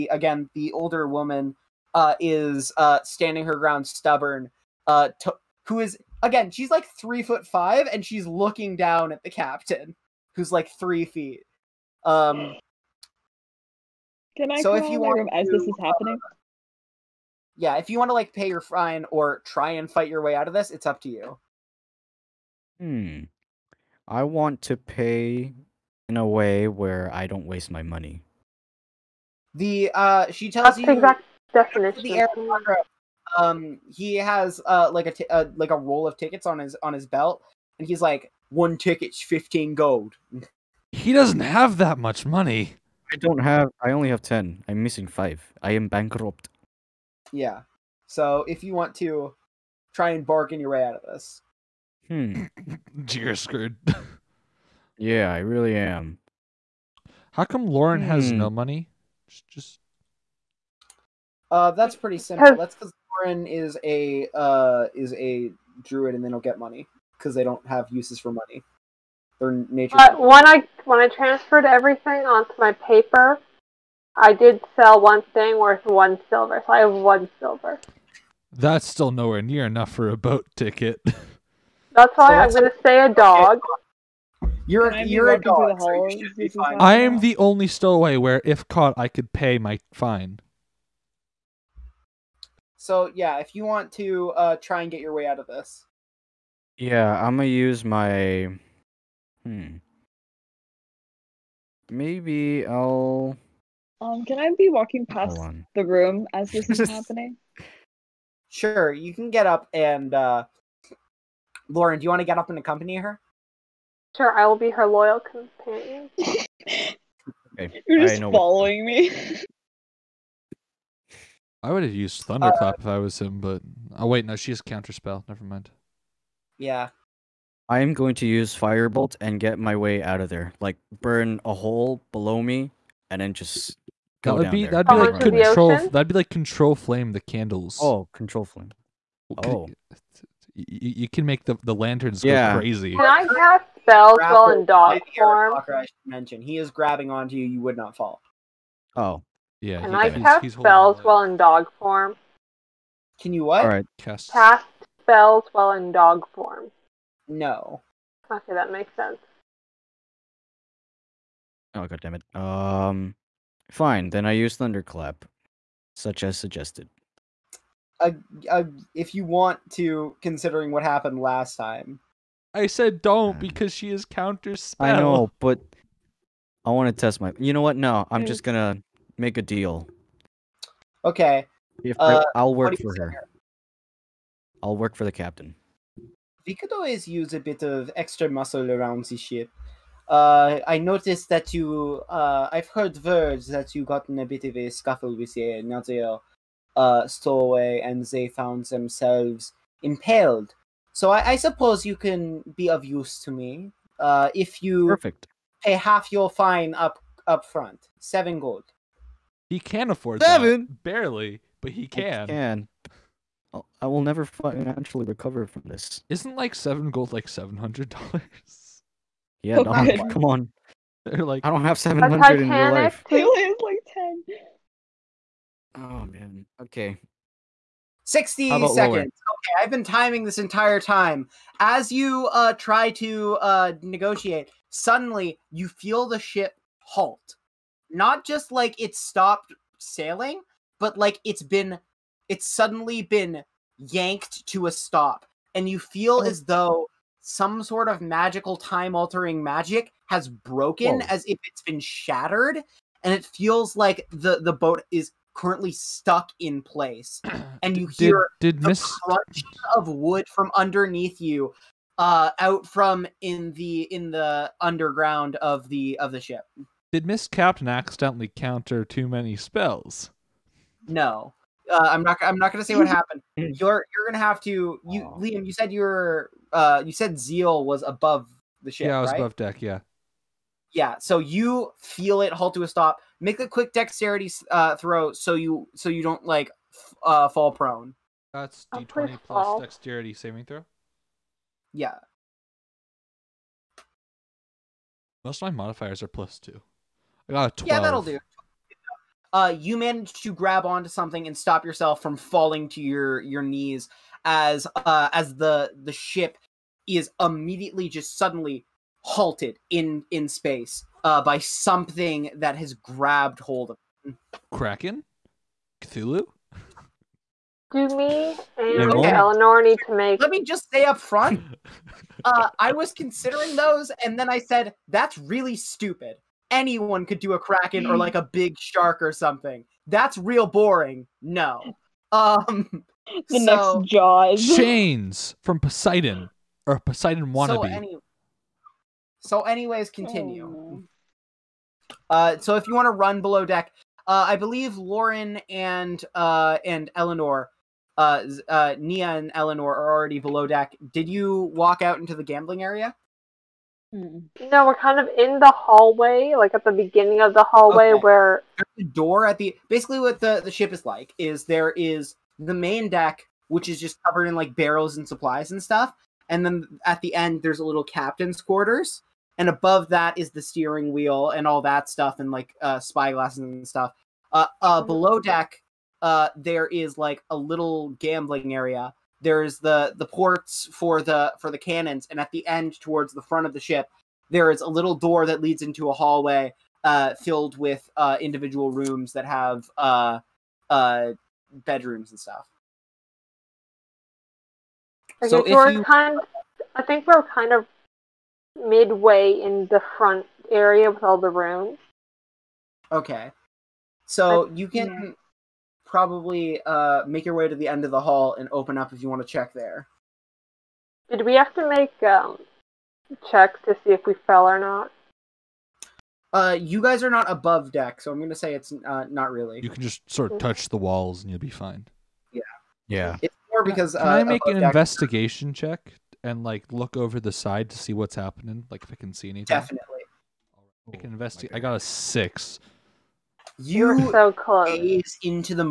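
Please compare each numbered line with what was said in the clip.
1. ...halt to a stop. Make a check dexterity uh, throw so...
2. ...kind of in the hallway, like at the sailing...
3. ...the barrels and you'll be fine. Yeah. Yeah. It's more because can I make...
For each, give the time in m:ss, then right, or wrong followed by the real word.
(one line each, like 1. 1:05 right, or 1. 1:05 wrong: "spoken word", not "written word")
1. 4:42 wrong: "quick", not "check"
2. 5:54 wrong: "beginning", not "sailing"
3. 7:00 wrong: "walls", not "barrels".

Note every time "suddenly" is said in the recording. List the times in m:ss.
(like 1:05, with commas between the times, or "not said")
3:54, 4:02, 5:08.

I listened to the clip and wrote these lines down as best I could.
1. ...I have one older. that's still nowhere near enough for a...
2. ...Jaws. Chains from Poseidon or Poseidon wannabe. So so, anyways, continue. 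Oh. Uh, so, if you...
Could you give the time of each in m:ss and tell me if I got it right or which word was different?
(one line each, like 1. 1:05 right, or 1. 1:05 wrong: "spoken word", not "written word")
1. 1:16 wrong: "silver", not "older"
2. 5:33 right.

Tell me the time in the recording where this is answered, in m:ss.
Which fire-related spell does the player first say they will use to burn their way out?
2:08.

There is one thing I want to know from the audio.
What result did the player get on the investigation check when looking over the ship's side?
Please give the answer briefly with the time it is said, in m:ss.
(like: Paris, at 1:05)
6, at 7:11.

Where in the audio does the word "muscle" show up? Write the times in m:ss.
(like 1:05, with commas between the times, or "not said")
3:08.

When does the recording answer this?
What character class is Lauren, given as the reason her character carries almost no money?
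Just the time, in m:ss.
1:05.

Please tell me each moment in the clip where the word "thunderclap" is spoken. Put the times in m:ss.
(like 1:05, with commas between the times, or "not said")
2:02, 2:44.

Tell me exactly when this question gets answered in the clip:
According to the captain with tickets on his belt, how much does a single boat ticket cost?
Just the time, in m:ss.
0:39.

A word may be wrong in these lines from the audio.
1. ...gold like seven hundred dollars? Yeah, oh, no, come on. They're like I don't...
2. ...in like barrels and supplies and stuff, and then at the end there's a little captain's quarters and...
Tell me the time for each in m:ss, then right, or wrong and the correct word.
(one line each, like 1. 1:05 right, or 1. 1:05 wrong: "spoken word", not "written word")
1. 3:36 right
2. 6:04 right.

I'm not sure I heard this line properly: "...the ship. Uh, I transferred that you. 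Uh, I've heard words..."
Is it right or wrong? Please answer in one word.
wrong.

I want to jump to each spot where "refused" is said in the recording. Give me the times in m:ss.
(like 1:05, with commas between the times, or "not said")
not said.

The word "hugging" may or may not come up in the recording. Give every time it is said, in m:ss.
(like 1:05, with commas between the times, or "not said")
not said.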